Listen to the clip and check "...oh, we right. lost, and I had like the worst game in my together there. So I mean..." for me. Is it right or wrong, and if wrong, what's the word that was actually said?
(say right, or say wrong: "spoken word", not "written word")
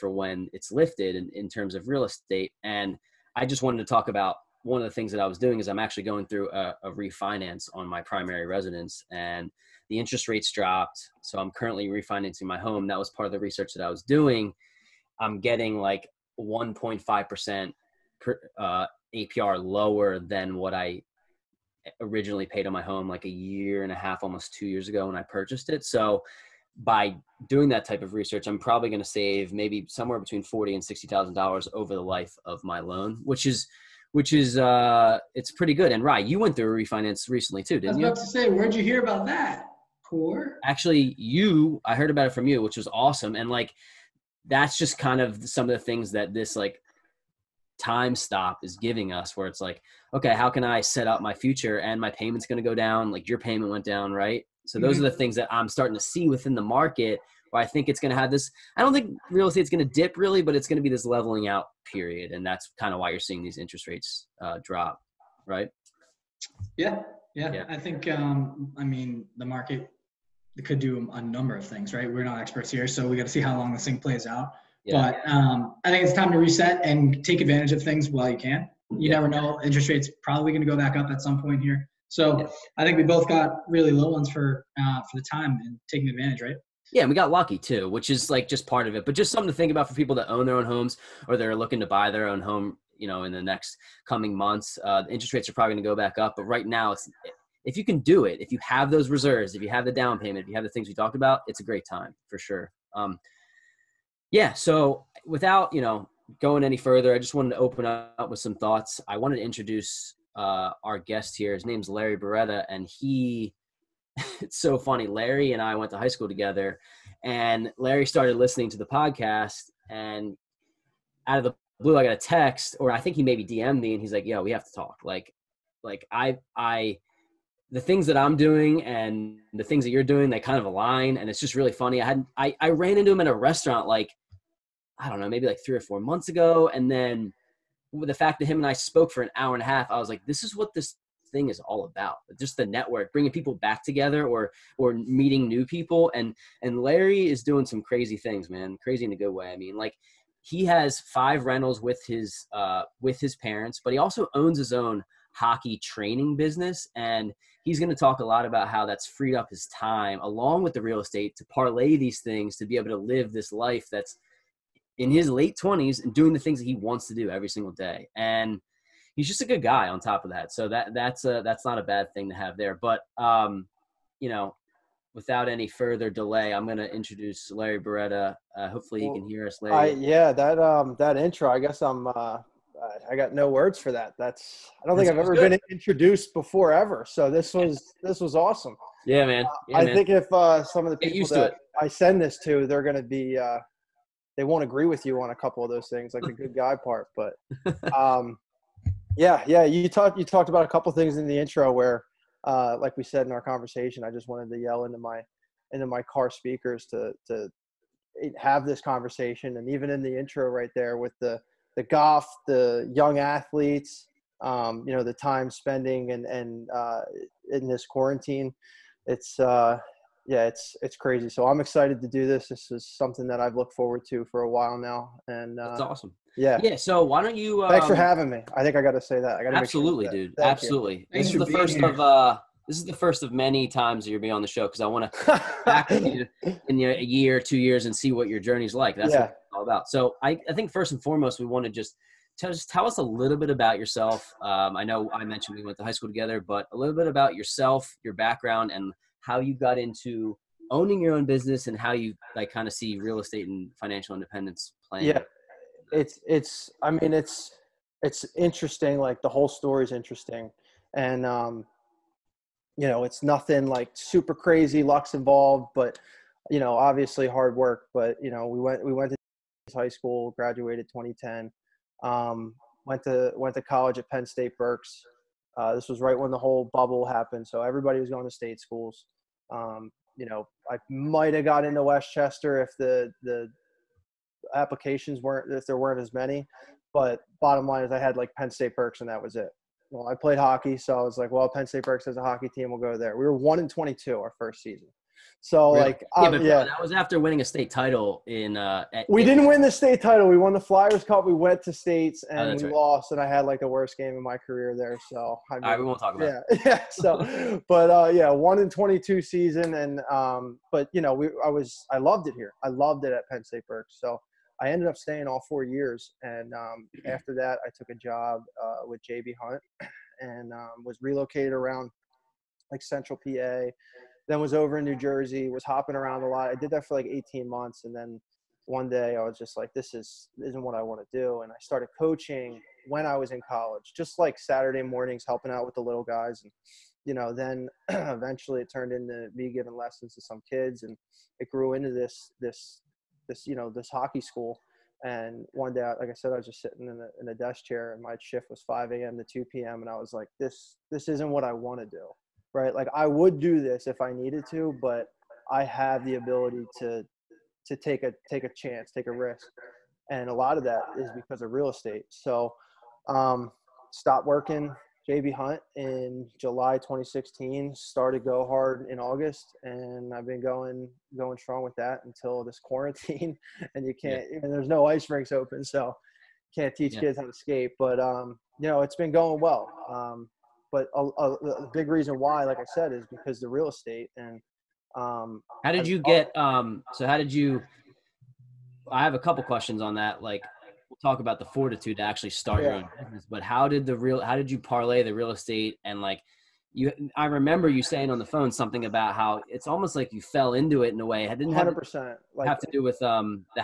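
wrong: "career", not "together".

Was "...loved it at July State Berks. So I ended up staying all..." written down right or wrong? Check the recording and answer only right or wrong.
wrong.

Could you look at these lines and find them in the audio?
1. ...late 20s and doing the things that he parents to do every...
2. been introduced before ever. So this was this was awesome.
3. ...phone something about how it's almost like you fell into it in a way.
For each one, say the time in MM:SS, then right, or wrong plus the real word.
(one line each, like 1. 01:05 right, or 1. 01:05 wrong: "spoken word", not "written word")
1. 02:45 wrong: "wants", not "parents"
2. 03:05 right
3. 06:38 right.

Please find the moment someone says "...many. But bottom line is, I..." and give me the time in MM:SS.
04:46.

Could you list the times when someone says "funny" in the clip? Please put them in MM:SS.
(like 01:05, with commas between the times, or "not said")
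01:54, 02:11.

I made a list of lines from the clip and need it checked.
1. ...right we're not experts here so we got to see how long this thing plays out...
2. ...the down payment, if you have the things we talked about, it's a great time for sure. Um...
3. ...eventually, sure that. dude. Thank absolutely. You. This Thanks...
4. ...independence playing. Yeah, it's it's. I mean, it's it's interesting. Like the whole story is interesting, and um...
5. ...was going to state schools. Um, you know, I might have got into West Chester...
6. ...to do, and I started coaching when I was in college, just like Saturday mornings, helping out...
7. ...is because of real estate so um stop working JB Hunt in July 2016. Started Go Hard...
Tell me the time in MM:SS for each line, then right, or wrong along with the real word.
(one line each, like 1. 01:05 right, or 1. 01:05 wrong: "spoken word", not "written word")
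1. 01:11 right
2. 01:39 right
3. 03:49 wrong: "absolutely", not "eventually"
4. 04:14 right
5. 04:37 right
6. 05:31 right
7. 06:00 right.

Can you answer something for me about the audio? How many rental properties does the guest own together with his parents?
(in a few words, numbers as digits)
5.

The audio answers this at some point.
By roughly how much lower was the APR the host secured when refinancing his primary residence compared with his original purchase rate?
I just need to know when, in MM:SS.
00:16.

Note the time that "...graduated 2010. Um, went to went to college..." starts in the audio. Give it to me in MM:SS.
04:30.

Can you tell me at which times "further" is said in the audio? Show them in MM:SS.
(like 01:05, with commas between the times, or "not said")
01:46, 02:55.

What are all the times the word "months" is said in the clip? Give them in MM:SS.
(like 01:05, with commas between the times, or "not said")
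01:34, 02:16, 05:27.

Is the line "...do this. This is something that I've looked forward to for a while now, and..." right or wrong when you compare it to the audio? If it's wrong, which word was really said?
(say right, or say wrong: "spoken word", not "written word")
right.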